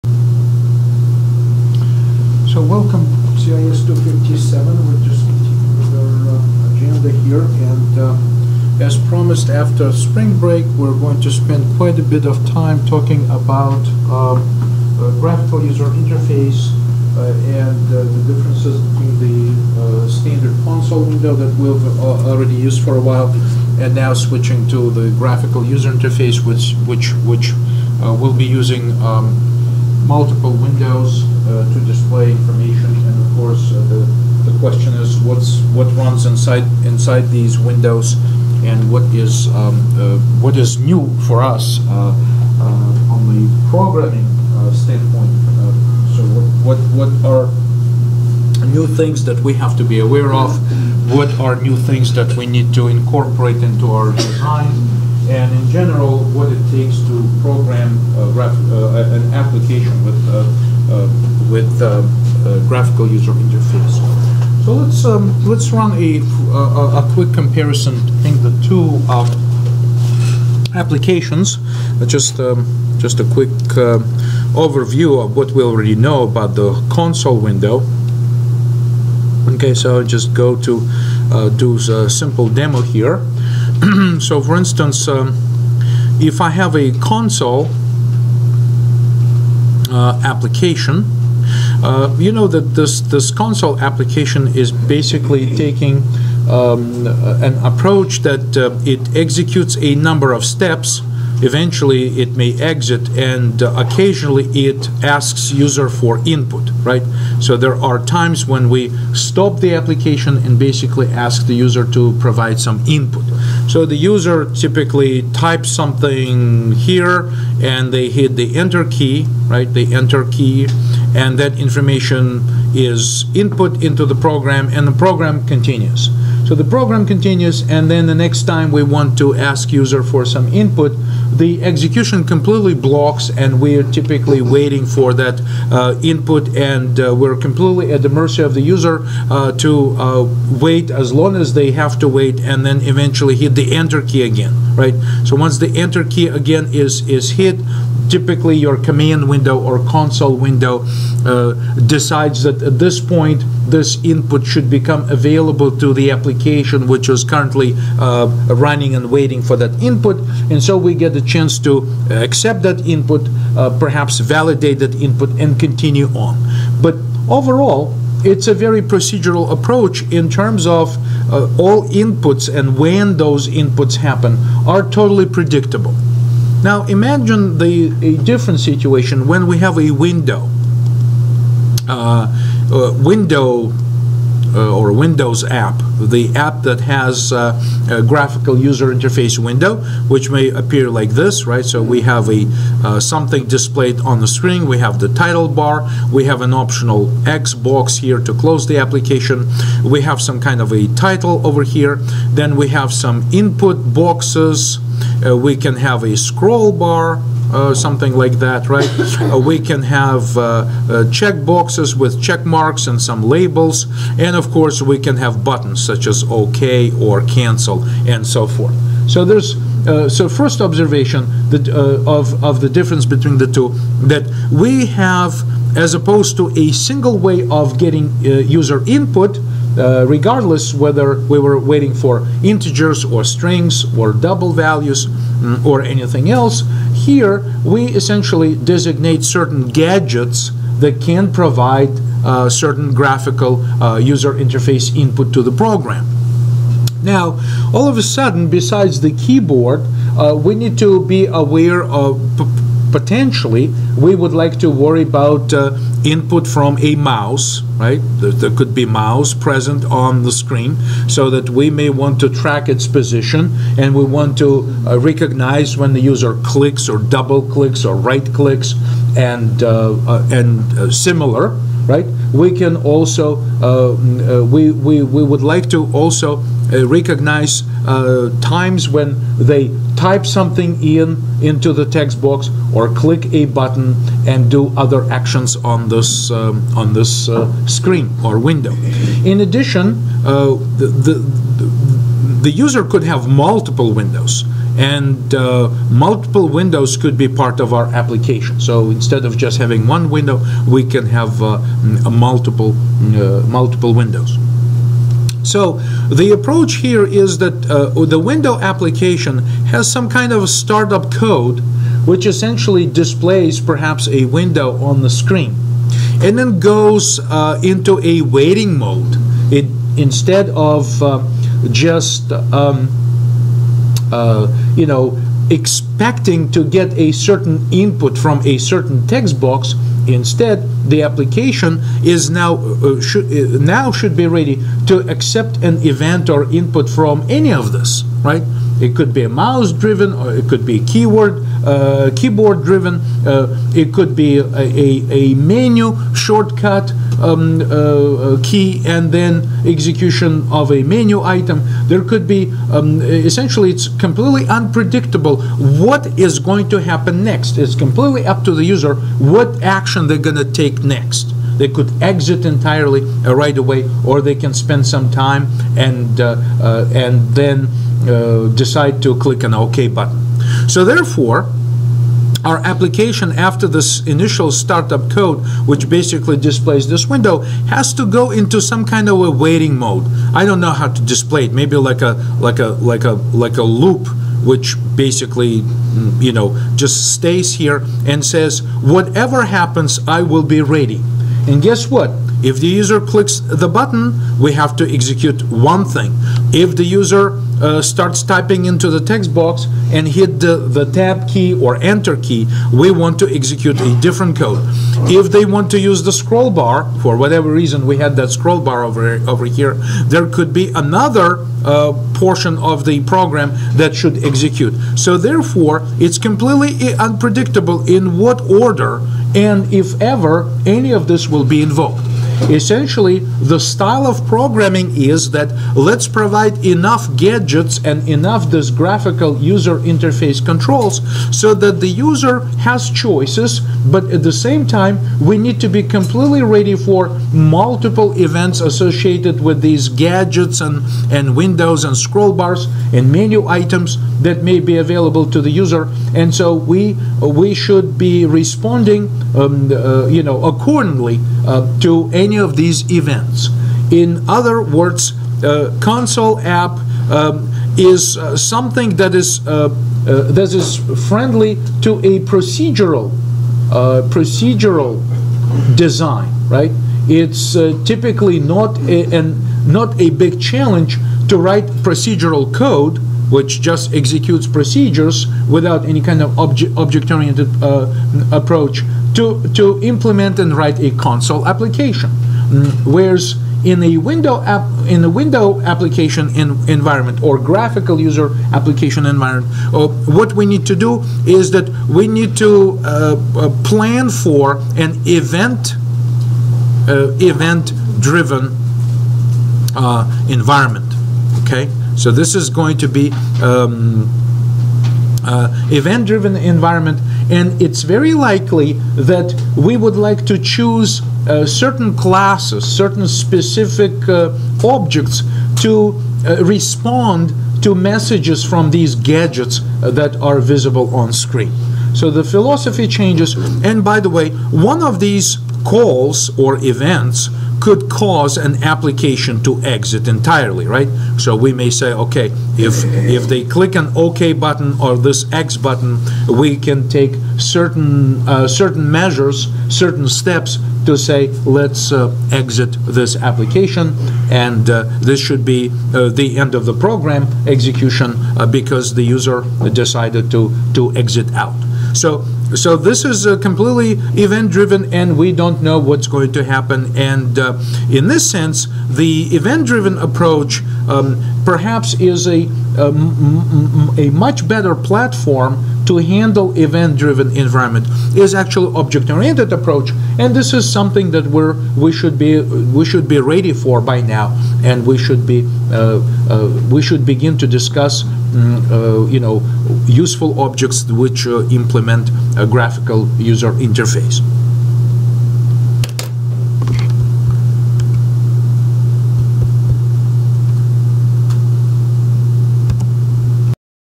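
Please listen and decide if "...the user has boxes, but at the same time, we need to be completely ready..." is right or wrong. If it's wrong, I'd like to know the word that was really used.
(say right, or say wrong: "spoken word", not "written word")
wrong: "choices", not "boxes".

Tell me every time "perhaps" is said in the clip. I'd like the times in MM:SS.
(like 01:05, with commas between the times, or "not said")
02:43, 05:13, 09:21.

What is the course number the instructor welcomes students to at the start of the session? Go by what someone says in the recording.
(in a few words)
CIS 257.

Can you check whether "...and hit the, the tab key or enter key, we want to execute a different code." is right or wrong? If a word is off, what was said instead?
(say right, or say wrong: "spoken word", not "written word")
right.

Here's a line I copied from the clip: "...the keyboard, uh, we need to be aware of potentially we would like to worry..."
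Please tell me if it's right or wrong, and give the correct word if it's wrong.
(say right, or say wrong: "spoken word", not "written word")
right.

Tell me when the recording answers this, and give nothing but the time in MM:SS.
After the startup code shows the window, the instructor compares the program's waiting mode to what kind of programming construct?
06:23.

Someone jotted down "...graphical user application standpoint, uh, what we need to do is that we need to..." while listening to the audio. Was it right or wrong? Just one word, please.
wrong.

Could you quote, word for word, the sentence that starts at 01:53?
So the user typically types something here and they hit the enter key, right?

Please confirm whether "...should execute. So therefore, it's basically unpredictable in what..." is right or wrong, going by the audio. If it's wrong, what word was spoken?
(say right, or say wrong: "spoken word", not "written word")
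wrong: "completely", not "basically".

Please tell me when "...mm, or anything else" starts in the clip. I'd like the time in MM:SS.
03:55.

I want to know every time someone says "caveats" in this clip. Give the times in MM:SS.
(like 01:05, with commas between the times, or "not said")
not said.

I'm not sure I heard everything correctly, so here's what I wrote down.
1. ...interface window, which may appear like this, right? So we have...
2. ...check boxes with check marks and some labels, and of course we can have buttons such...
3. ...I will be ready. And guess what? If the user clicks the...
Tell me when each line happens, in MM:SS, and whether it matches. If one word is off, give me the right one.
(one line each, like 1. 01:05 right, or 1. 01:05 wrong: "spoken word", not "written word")
1. 03:08 right
2. 03:31 right
3. 06:30 right.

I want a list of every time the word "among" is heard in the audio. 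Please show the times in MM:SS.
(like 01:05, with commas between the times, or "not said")
not said.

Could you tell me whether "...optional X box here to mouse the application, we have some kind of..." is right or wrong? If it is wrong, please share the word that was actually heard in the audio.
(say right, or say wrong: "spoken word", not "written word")
wrong: "close", not "mouse".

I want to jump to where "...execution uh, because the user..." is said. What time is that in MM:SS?
09:07.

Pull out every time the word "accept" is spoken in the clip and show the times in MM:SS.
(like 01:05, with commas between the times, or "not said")
02:42, 05:35.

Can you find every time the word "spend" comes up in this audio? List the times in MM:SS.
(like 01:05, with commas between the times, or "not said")
00:11, 06:04.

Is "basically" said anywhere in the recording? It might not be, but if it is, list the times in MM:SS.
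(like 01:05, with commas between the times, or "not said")
01:34, 01:50, 06:15, 06:24.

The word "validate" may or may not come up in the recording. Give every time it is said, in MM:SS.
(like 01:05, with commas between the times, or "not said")
02:44.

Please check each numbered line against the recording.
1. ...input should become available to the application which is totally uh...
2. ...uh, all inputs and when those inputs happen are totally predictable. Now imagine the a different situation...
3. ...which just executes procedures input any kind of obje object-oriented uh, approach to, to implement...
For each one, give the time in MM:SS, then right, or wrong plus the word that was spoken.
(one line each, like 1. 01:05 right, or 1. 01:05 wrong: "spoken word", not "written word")
1. 02:34 wrong: "currently", not "totally"
2. 02:51 right
3. 07:53 wrong: "without", not "input".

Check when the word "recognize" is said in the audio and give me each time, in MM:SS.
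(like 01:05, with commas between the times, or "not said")
04:24, 04:36.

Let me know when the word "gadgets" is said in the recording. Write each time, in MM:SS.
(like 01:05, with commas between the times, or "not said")
03:59, 07:07, 07:19, 08:38.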